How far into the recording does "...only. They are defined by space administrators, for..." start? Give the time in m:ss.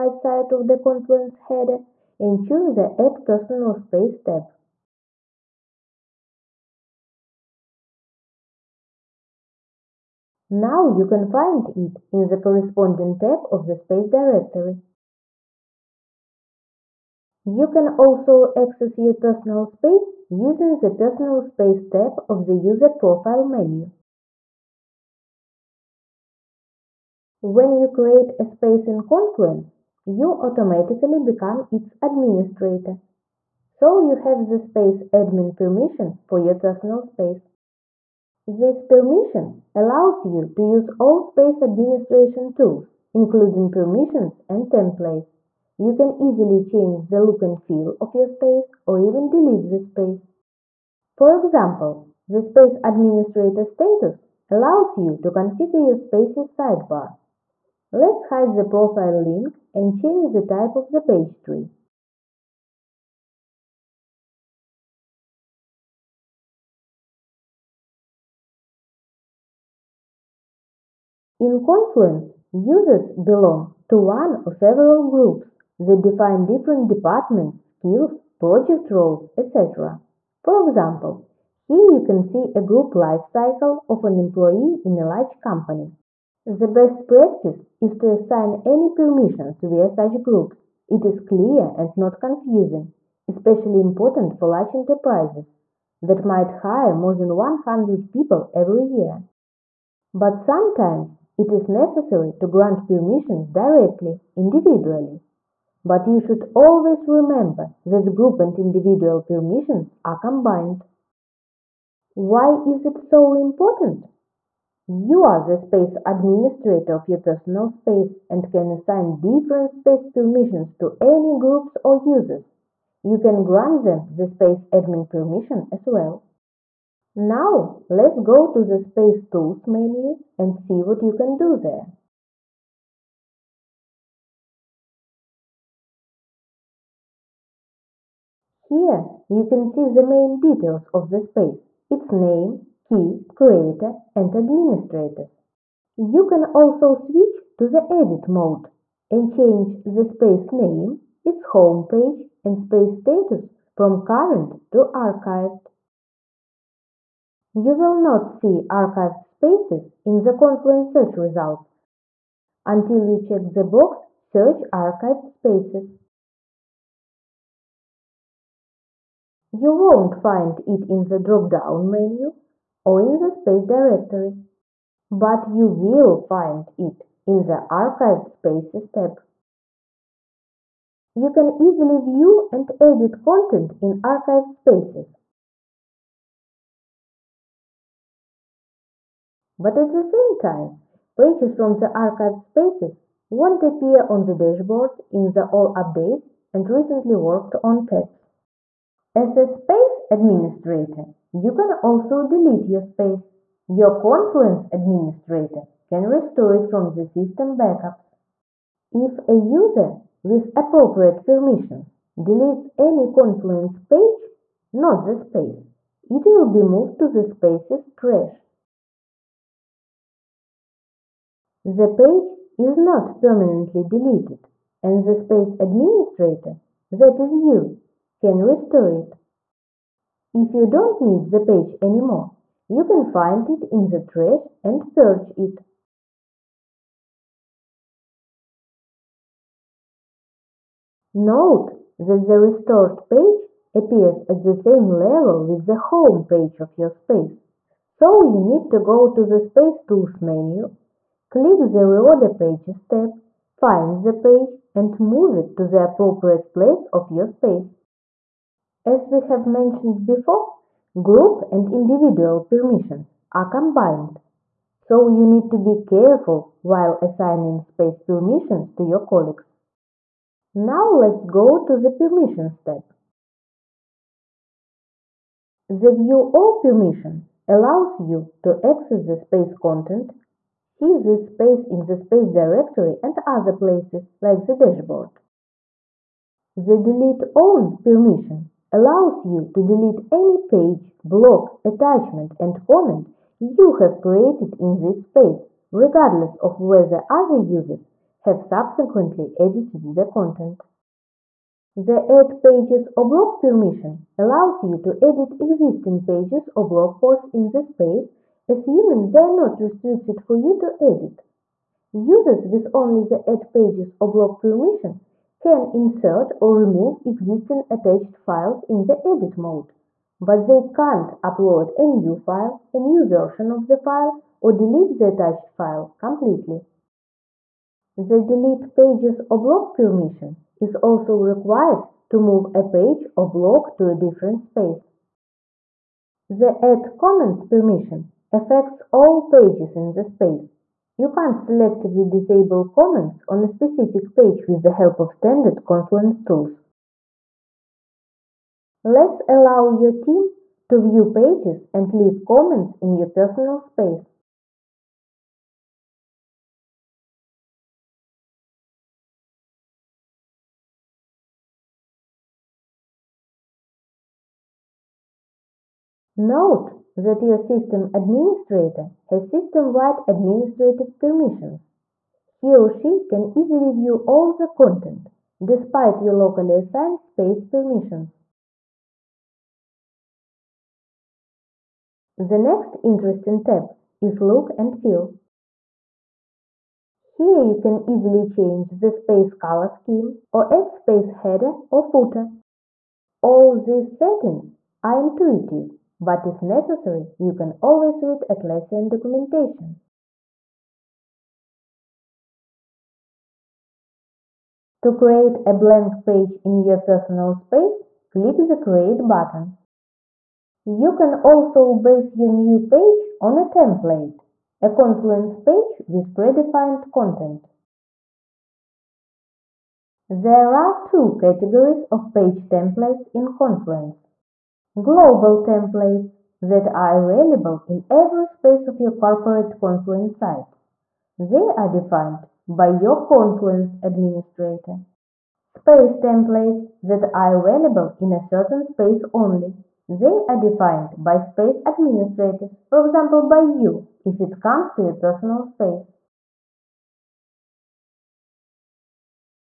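7:19.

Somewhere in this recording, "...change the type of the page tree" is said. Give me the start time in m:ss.
0:59.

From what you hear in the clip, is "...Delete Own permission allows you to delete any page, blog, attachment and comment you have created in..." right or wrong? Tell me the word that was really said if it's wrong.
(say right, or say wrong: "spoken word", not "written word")
right.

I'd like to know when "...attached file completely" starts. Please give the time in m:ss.
5:25.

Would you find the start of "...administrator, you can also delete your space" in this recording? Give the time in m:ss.
3:20.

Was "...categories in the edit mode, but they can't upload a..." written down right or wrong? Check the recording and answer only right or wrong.
wrong.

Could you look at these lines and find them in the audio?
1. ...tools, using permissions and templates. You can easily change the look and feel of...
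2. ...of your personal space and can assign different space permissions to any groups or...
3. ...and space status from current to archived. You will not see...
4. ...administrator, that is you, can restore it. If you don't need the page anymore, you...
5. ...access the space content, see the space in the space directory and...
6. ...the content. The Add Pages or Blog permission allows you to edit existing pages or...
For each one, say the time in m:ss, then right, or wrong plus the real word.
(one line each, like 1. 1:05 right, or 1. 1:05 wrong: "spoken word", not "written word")
1. 0:42 wrong: "including", not "using"
2. 1:56 right
3. 2:32 right
4. 3:45 right
5. 4:38 right
6. 4:59 right.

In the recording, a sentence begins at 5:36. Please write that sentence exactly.
The add comments permission affects all pages in the space.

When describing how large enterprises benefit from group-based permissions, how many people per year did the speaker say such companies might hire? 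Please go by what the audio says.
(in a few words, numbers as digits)
more than 100.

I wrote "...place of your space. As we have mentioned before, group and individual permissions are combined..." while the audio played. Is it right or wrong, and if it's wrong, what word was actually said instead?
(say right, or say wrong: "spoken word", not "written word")
right.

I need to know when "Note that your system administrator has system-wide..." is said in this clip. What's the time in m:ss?
6:06.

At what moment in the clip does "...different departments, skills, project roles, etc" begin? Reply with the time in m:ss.
1:16.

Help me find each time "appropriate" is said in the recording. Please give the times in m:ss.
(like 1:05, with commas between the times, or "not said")
3:30, 4:15.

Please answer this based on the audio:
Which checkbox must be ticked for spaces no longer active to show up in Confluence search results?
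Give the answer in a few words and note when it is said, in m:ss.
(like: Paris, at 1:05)
Search Archived Spaces, at 2:44.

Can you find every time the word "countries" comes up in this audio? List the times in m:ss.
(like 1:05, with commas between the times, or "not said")
not said.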